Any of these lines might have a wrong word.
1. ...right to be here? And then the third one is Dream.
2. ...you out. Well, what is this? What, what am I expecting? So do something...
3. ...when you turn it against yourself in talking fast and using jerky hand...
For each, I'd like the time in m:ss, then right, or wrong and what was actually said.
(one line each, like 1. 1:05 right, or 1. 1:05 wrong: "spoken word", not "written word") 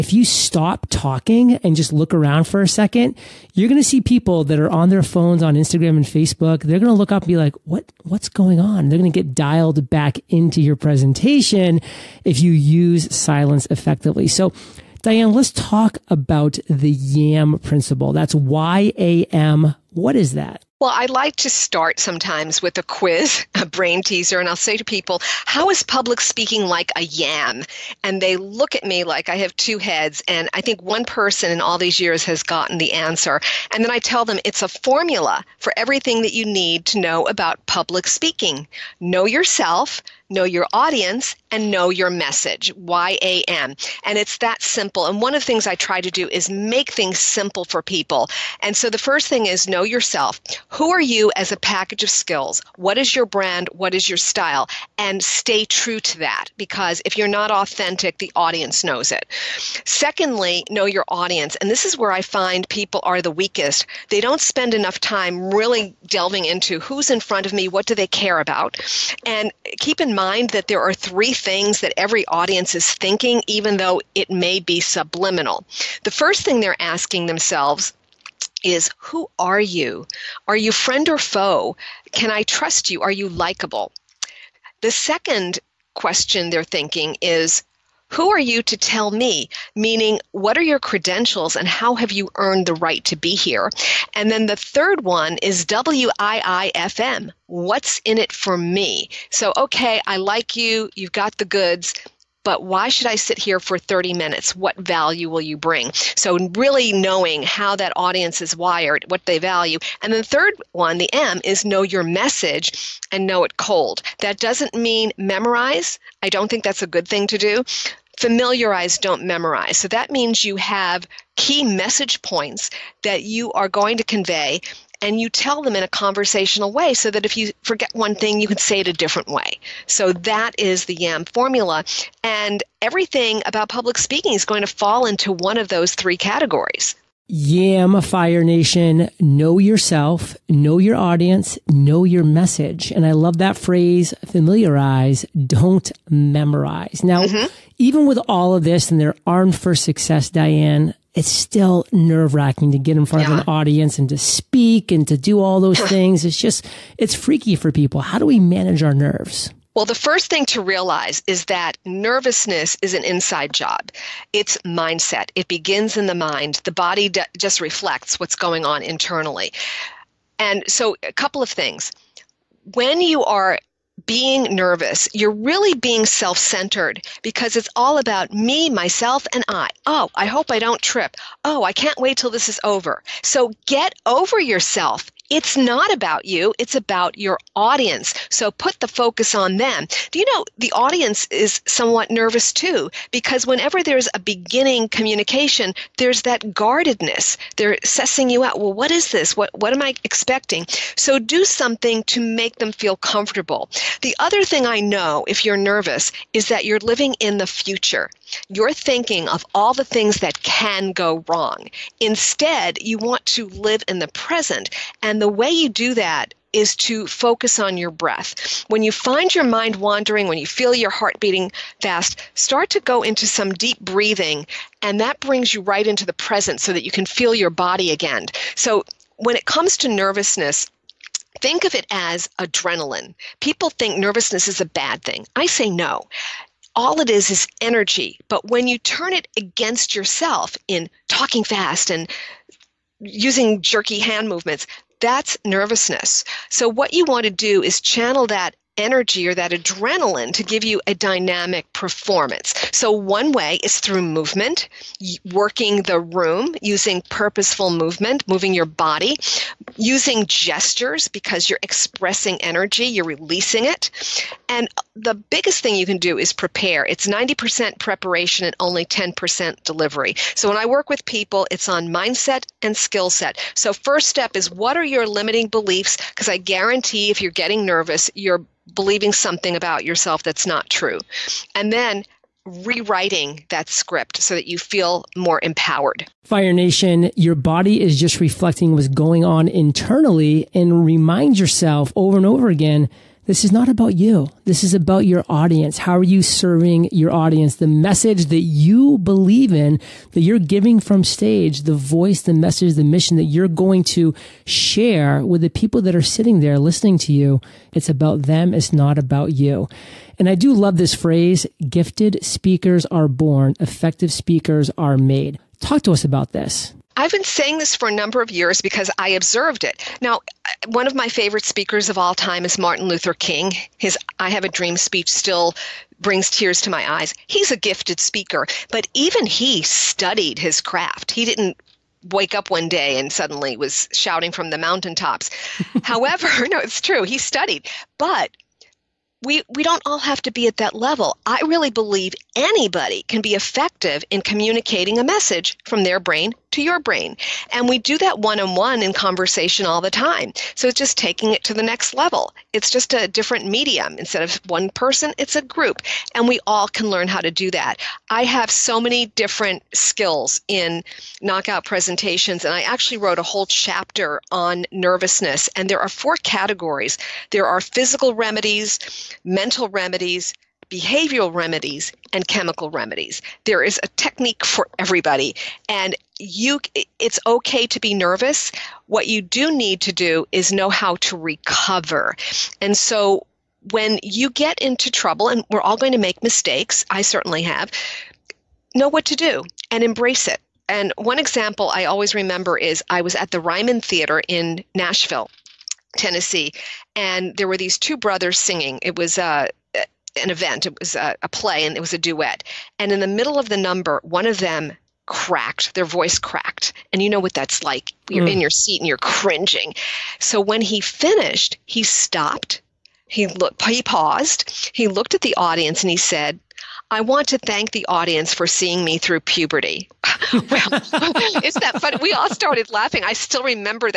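1. 1:32 wrong: "WIIFM", not "Dream"
2. 3:18 right
3. 3:58 right.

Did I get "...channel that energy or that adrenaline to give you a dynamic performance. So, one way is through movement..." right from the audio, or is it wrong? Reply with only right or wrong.
right.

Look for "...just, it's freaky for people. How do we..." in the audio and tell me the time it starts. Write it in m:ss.
2:36.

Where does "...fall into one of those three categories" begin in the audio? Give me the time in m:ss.
2:14.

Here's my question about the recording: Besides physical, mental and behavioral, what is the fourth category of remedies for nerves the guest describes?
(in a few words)
chemical.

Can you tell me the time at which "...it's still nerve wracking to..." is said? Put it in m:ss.
2:31.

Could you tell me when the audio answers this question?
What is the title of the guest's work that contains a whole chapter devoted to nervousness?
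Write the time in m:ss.
6:01.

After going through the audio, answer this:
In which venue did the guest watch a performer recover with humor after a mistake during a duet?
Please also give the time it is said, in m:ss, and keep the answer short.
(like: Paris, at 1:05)
Ryman Theater, at 6:33.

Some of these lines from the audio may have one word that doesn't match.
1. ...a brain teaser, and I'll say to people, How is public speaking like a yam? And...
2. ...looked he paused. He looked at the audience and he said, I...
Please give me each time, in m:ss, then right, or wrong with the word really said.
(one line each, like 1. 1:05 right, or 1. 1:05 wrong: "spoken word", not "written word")
1. 0:23 right
2. 6:53 right.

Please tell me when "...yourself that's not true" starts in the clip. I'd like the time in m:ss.
4:39.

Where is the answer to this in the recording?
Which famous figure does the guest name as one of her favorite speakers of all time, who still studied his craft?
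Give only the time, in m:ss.
5:22.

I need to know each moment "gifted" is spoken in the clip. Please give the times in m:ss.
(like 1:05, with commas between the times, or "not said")
5:11, 5:27.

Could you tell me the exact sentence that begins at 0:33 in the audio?
And then I tell them it's a formula for everything that you need to know about public speaking.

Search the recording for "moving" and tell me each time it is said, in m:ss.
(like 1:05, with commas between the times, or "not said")
4:18.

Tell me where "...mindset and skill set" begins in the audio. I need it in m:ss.
4:31.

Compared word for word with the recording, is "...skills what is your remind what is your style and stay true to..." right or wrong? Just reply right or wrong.
wrong.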